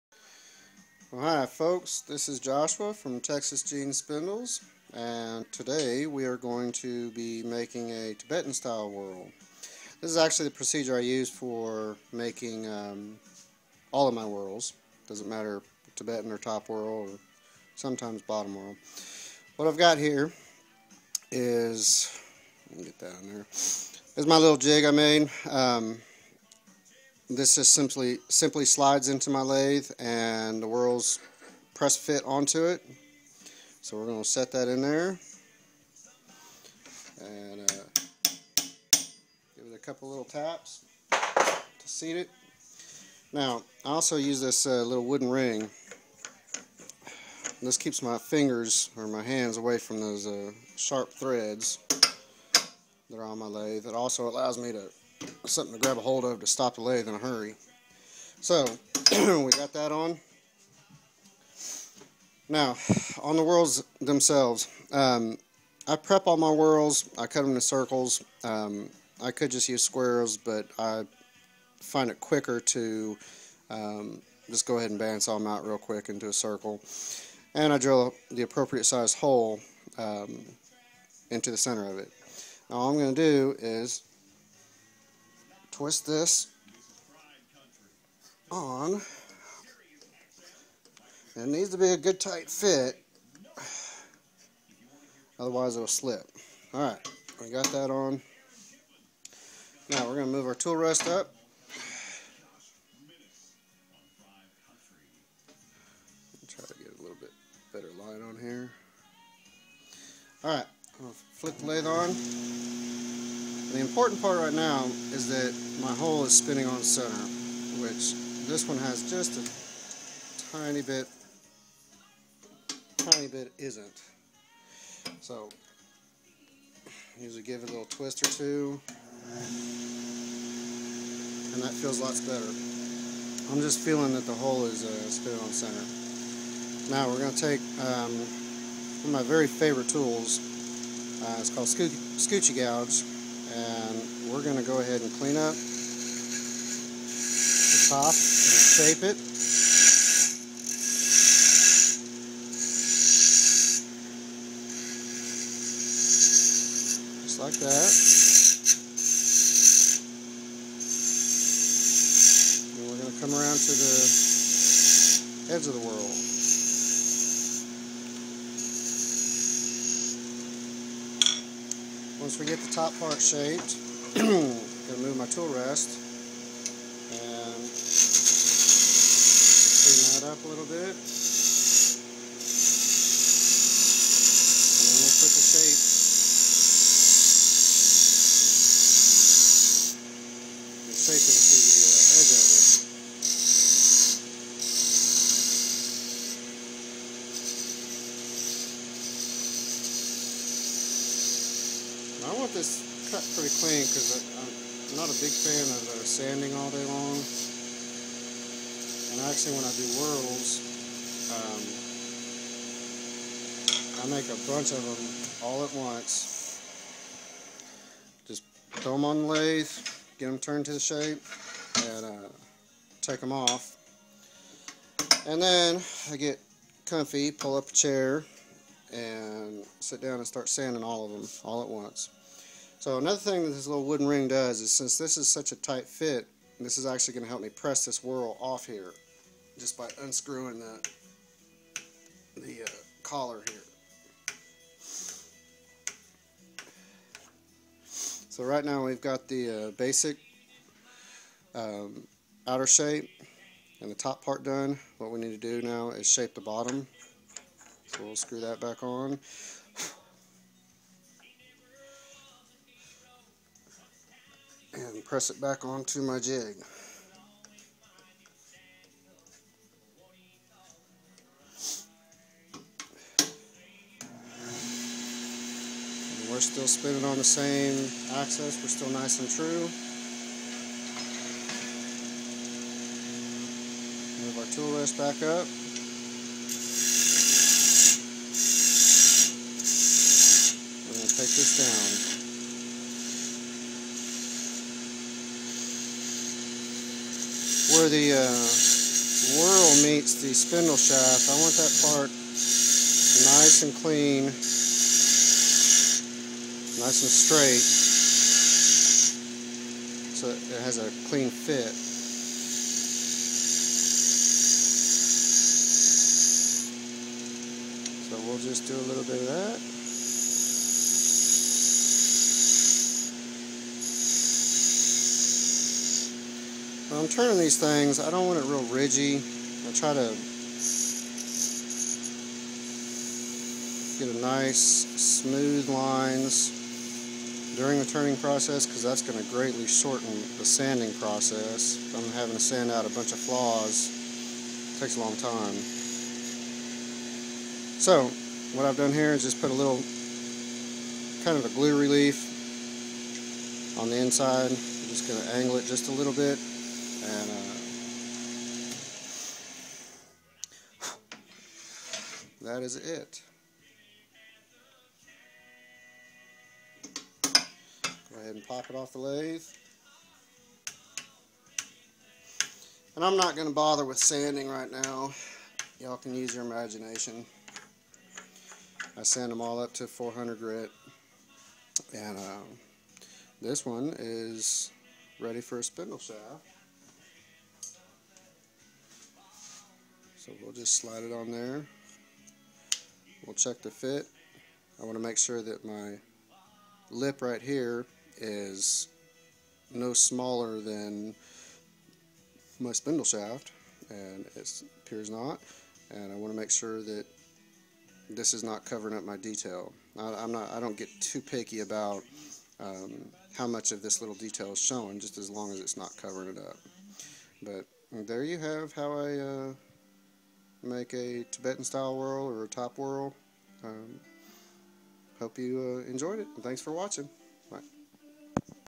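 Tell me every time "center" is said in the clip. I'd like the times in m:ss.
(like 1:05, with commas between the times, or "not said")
1:21, 1:56, 2:15.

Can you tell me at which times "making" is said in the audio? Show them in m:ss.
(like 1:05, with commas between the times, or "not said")
0:07, 0:12.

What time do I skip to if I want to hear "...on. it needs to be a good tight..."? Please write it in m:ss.
1:28.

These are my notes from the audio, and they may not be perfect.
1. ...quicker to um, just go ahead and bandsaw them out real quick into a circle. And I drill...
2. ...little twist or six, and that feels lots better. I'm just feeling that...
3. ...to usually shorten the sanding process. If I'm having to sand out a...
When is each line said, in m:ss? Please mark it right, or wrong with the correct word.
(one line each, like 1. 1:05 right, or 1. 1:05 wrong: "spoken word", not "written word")
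1. 1:12 right
2. 2:07 wrong: "two", not "six"
3. 5:39 wrong: "greatly", not "usually".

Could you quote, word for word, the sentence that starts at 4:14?
What we need to do now is shape the bottom so we'll screw that back on.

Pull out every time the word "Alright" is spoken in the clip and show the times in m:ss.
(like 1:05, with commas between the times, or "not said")
1:36, 1:50.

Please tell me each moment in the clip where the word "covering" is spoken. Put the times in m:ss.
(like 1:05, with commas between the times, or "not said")
6:48, 6:55.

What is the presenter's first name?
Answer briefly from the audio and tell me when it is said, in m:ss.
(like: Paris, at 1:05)
Joshua, at 0:02.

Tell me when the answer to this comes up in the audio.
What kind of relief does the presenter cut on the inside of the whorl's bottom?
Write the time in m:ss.
5:51.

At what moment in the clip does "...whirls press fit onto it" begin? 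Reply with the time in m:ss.
0:30.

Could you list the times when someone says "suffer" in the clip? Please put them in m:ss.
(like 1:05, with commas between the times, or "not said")
not said.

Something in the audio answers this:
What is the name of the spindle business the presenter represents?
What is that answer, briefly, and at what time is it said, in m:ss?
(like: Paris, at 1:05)
Texas Jeans Spindles, at 0:03.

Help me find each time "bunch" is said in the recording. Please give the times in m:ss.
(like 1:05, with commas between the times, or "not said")
3:34, 5:42.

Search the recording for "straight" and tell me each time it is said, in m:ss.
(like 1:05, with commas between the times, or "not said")
5:07.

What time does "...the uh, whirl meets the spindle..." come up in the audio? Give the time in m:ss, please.
4:57.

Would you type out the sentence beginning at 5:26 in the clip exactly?
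When I'm turning these things, I don't want it real ridgy.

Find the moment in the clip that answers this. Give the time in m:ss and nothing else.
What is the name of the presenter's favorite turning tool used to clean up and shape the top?
2:21.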